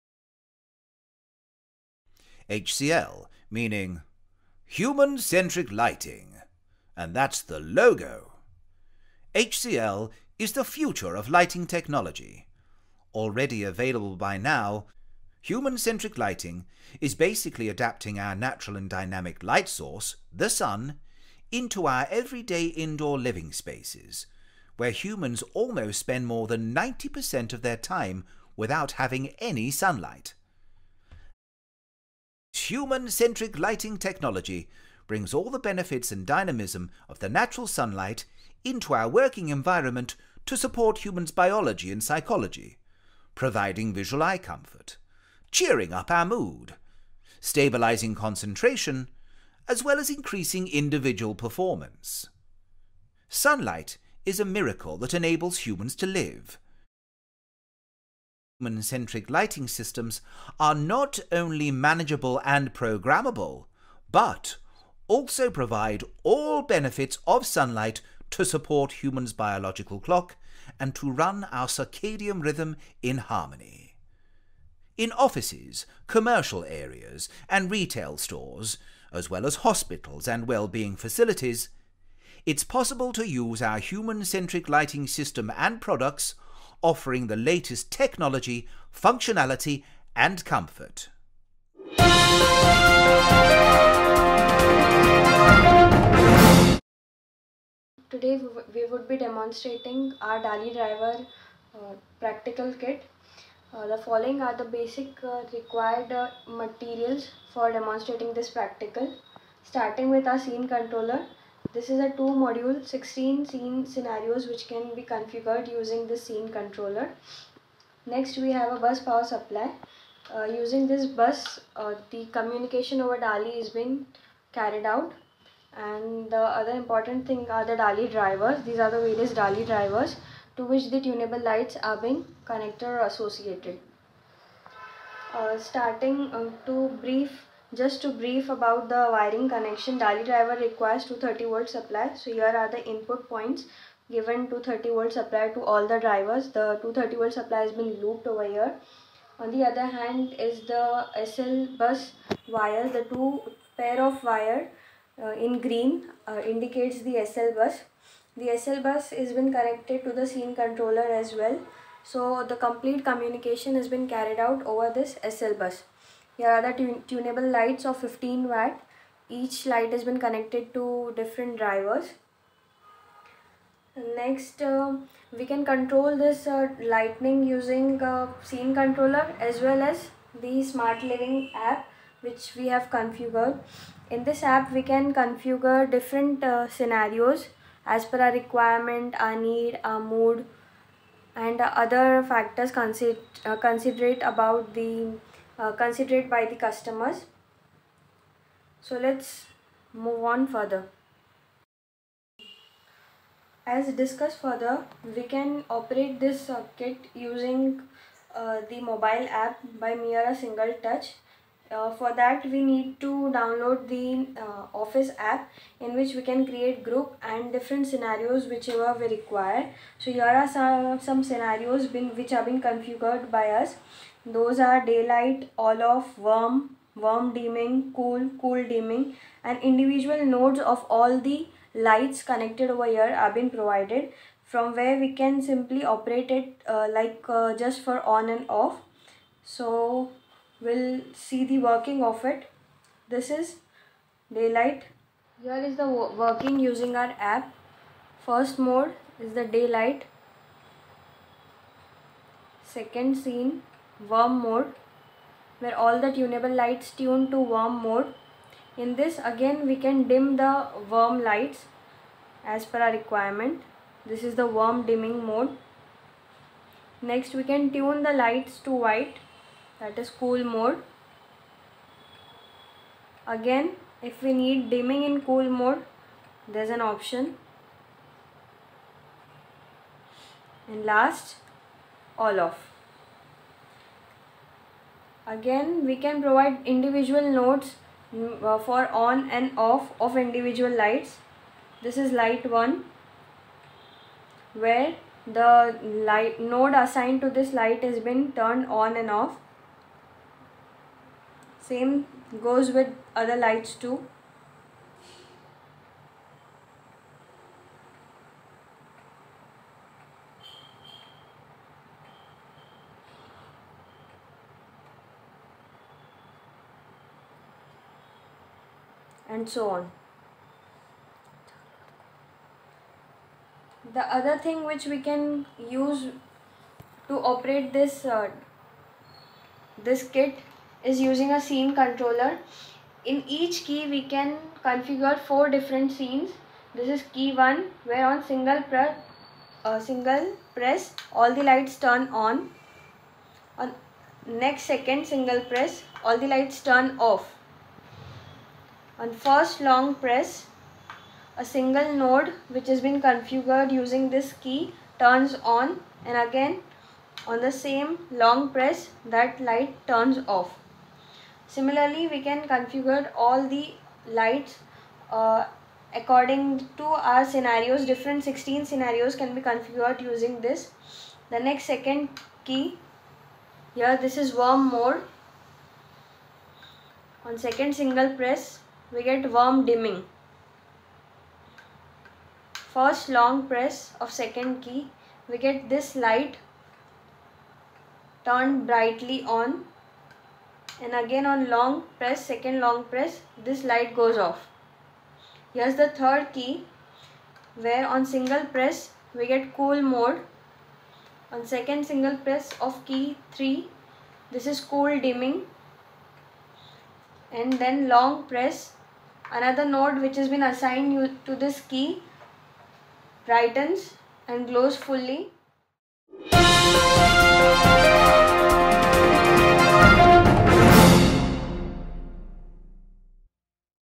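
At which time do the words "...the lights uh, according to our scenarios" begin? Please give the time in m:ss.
6:03.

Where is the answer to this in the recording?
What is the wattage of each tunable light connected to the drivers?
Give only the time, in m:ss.
2:47.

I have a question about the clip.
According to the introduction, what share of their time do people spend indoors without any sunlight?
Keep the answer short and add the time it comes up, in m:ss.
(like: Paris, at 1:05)
more than 90%, at 0:26.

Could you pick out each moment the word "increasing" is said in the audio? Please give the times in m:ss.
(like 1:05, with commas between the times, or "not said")
0:50.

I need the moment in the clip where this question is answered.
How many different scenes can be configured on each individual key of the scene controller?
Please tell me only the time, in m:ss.
5:35.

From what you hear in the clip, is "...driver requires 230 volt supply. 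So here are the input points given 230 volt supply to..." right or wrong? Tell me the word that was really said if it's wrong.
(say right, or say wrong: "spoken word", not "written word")
right.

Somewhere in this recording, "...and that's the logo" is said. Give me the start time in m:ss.
0:06.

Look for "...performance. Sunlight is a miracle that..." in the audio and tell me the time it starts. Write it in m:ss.
0:51.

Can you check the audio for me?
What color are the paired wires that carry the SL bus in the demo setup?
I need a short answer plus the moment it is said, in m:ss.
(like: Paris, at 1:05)
green, at 2:35.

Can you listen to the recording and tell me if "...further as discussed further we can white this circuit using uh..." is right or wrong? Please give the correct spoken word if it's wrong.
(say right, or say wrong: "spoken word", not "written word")
wrong: "operate", not "white".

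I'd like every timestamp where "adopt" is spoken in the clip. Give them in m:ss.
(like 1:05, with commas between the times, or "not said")
not said.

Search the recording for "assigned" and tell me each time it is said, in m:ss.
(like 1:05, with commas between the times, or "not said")
4:56, 6:50.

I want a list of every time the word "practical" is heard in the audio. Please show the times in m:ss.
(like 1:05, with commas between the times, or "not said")
1:42, 1:48.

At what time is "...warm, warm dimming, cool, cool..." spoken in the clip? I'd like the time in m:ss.
3:46.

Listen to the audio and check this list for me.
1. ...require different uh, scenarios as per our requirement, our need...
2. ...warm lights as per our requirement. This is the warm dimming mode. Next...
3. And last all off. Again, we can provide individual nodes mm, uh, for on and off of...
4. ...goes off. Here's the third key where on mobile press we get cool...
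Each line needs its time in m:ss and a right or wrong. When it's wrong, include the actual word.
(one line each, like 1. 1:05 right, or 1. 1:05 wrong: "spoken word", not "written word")
1. 3:05 wrong: "configure", not "require"
2. 4:20 right
3. 4:40 right
4. 6:33 wrong: "single", not "mobile".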